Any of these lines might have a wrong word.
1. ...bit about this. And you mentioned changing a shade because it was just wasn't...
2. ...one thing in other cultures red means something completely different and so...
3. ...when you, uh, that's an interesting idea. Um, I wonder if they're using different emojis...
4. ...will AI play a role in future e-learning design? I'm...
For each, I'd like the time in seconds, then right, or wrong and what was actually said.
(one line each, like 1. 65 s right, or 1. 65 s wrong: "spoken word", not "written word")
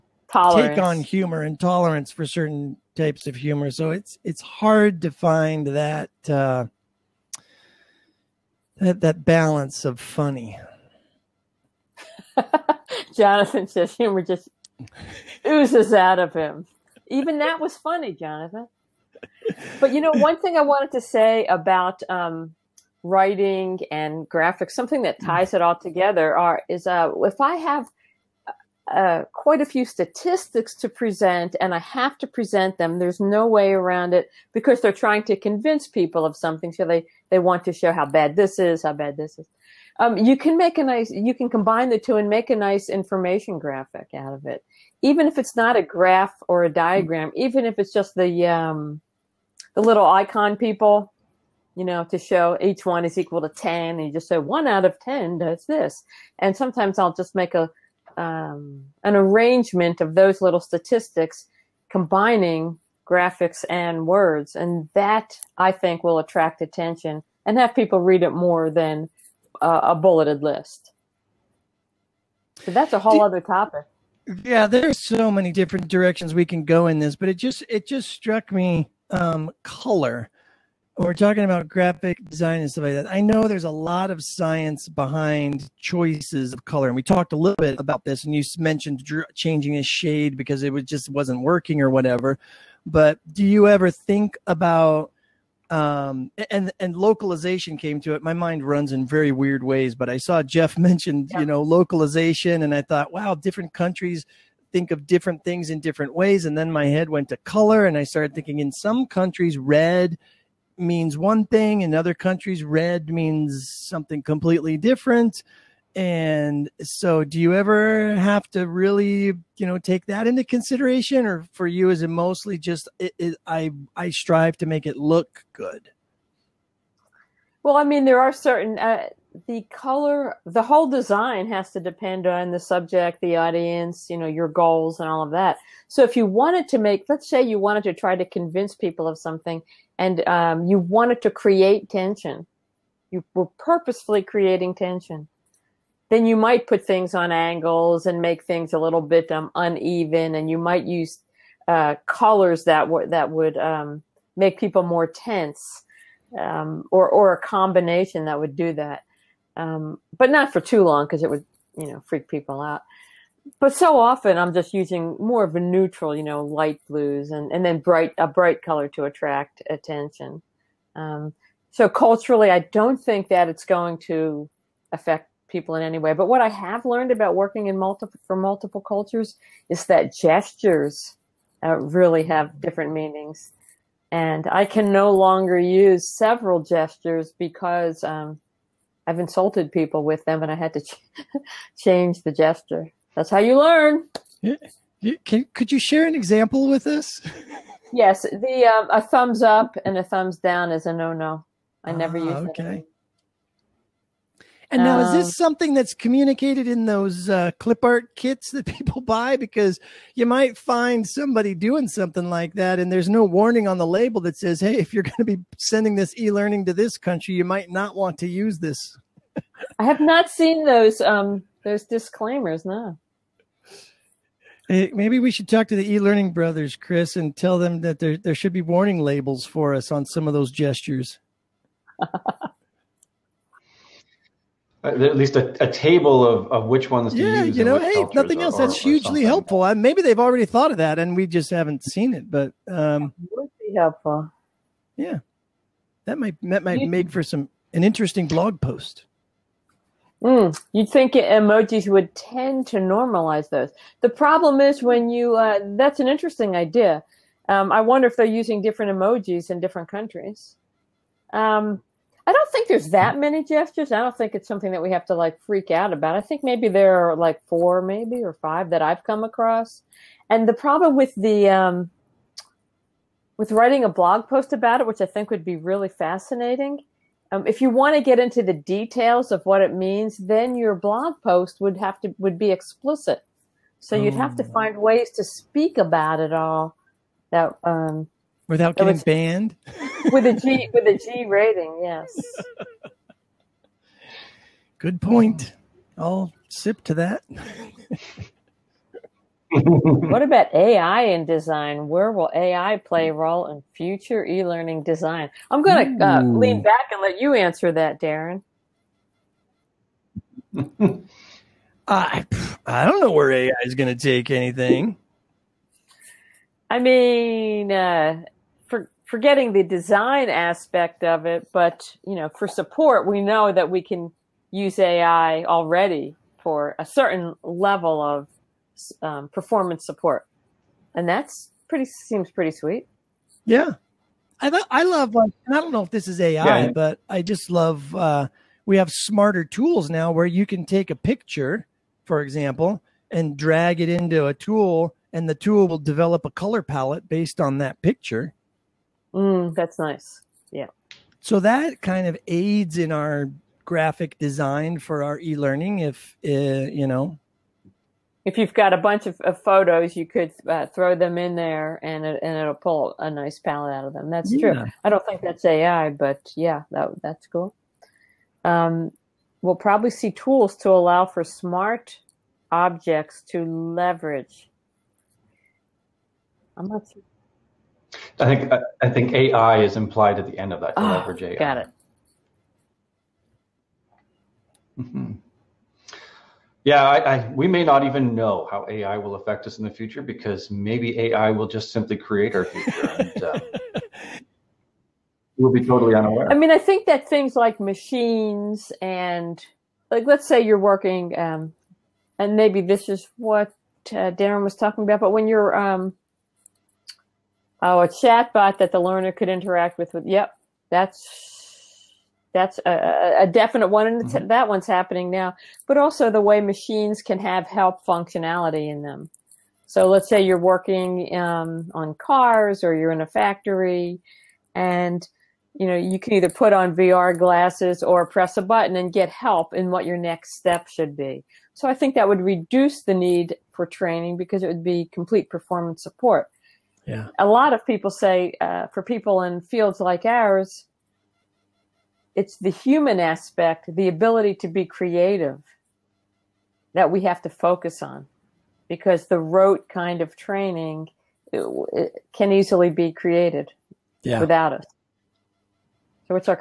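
1. 87 s right
2. 111 s wrong: "countries", not "cultures"
3. 254 s right
4. 302 s right.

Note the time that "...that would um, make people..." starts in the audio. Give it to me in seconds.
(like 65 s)
153 s.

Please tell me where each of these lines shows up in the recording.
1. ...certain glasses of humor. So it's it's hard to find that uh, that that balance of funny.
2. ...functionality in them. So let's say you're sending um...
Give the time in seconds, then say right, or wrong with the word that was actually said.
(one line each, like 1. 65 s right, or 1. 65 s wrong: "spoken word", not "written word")
1. 2 s wrong: "types", not "glasses"
2. 417 s wrong: "working", not "sending".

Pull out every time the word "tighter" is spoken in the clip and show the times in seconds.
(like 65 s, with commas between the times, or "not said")
not said.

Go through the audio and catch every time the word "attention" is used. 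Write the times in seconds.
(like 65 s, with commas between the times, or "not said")
66 s, 169 s.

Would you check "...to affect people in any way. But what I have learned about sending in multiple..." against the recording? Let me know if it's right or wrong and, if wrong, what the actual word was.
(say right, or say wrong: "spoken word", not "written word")
wrong: "working", not "sending".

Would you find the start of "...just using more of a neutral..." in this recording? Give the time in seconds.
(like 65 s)
164 s.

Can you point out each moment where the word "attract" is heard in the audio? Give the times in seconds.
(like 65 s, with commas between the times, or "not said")
66 s, 169 s.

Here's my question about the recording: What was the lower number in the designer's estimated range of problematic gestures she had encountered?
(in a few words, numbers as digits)
4.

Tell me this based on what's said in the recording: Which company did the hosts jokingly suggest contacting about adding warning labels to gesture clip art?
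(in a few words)
The e-learning brothers.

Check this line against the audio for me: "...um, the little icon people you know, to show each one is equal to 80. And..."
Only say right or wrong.
wrong.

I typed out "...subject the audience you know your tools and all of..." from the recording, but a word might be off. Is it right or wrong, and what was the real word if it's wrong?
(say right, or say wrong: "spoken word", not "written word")
wrong: "goals", not "tools".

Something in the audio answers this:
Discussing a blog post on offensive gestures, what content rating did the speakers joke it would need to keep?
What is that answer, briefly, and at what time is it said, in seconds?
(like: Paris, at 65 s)
G rating, at 290 s.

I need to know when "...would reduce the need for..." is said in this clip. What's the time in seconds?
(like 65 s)
432 s.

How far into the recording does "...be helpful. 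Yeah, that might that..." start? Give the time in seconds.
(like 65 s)
243 s.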